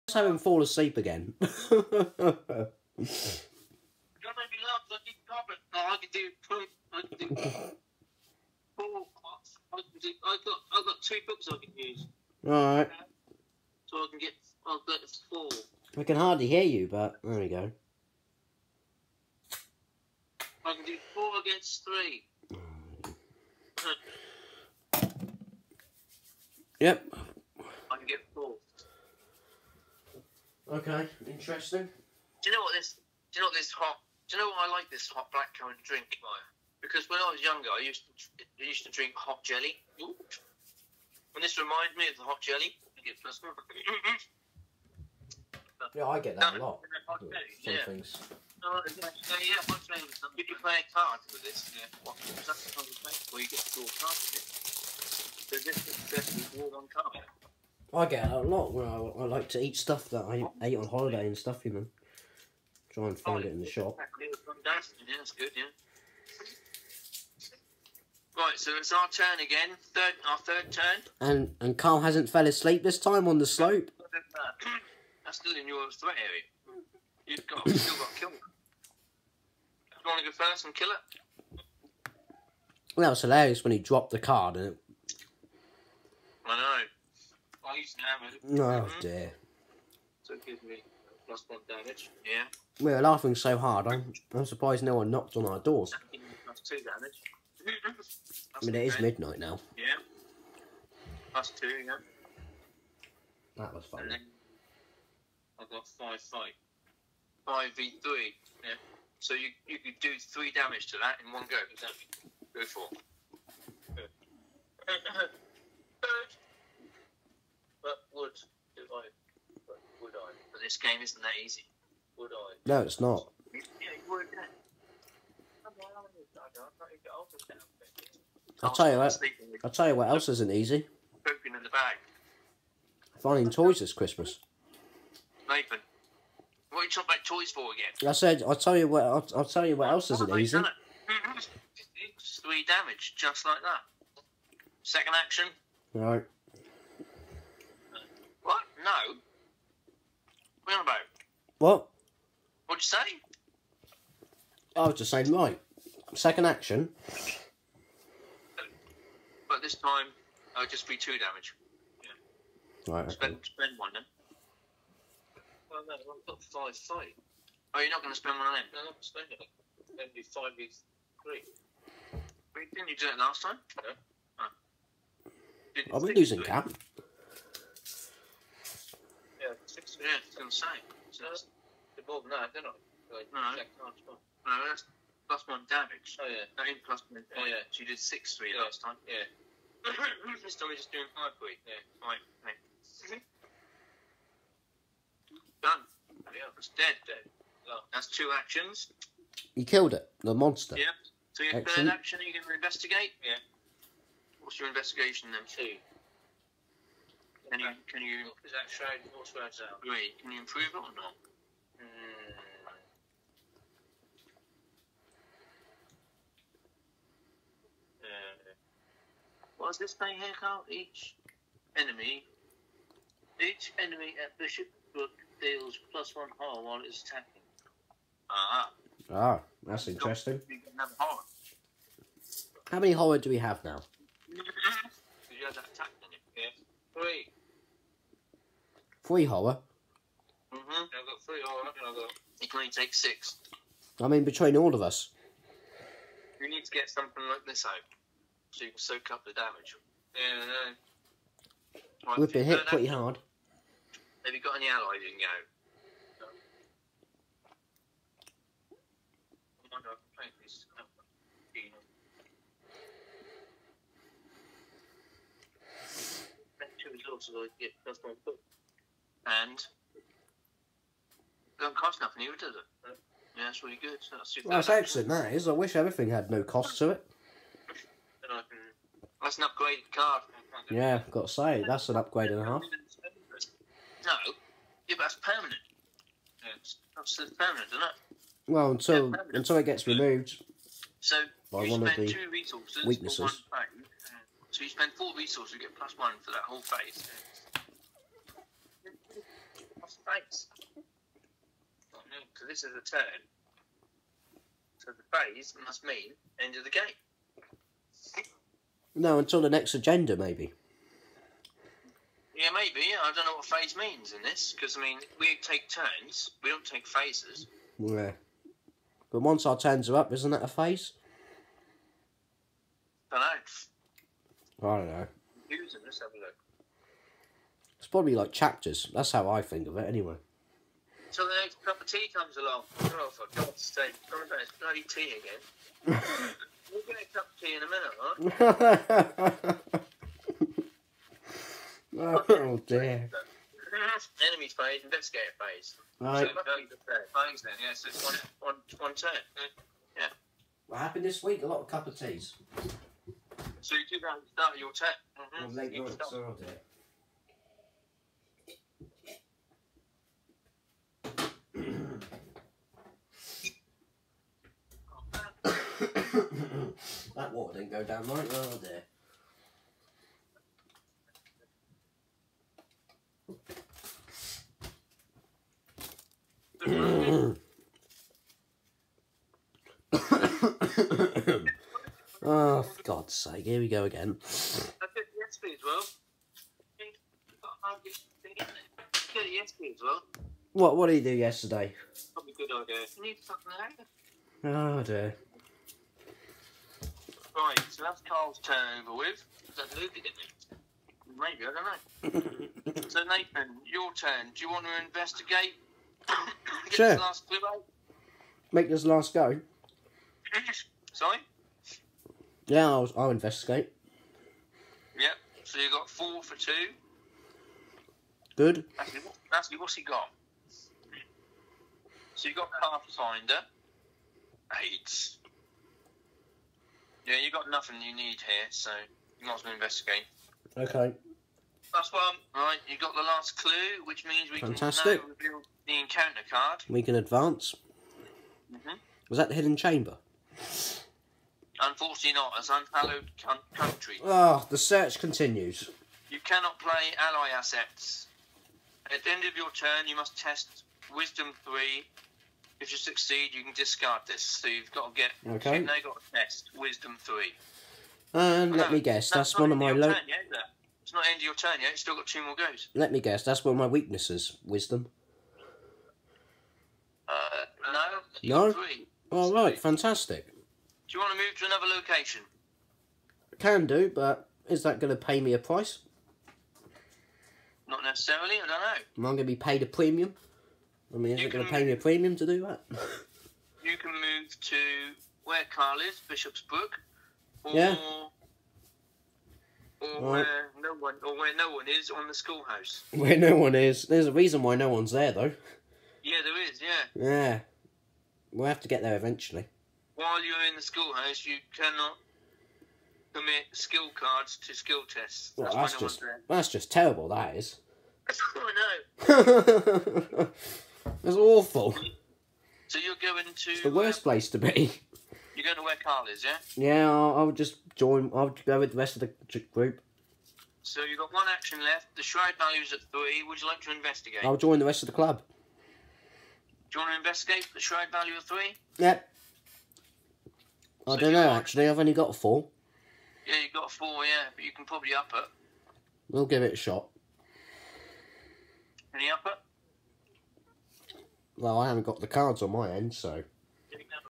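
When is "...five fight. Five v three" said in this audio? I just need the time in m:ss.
1:45.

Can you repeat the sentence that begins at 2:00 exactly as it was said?
But this game isn't that easy.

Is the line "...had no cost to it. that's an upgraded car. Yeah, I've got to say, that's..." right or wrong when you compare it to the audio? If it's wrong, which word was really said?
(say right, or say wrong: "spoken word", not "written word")
right.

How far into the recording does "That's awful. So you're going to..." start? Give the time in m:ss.
8:31.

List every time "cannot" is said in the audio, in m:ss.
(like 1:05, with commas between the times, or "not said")
7:26, 8:21.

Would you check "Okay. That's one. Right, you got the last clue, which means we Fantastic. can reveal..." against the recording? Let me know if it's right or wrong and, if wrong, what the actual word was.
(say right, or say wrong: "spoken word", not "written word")
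right.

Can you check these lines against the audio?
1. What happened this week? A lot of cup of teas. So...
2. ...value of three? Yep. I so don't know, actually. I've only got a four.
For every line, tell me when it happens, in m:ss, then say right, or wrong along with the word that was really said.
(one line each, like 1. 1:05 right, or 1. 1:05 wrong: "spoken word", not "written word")
1. 5:50 right
2. 8:47 right.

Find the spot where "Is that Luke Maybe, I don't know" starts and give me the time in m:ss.
6:39.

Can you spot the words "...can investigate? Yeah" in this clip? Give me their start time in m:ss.
3:22.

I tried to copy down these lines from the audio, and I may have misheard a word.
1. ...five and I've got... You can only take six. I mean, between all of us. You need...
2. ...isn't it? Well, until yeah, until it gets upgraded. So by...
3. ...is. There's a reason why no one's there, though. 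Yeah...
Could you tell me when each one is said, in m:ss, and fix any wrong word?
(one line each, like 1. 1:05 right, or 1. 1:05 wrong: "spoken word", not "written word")
1. 4:01 wrong: "three", not "five"
2. 4:47 wrong: "removed", not "upgraded"
3. 8:13 right.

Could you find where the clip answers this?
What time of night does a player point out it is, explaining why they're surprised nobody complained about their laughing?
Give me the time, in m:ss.
1:38.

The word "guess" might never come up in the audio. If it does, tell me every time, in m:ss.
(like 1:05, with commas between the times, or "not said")
7:38, 7:42.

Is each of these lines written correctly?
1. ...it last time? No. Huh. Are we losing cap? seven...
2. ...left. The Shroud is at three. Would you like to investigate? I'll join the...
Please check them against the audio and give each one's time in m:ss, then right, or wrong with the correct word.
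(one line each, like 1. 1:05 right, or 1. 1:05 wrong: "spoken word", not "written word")
1. 2:53 wrong: "six", not "seven"
2. 8:41 right.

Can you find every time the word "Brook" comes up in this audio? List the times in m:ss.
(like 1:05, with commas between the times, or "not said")
3:44, 8:06.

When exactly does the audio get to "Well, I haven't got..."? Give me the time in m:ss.
9:01.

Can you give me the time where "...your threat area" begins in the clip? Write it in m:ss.
1:15.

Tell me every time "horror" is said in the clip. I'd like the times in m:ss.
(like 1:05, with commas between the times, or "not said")
3:46, 3:52.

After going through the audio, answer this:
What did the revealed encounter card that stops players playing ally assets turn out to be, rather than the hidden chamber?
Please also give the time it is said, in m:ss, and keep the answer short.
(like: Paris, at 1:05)
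Unhallowed country, at 7:22.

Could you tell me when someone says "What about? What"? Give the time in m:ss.
2:30.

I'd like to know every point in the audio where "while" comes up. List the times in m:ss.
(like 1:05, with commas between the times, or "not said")
3:46, 8:19.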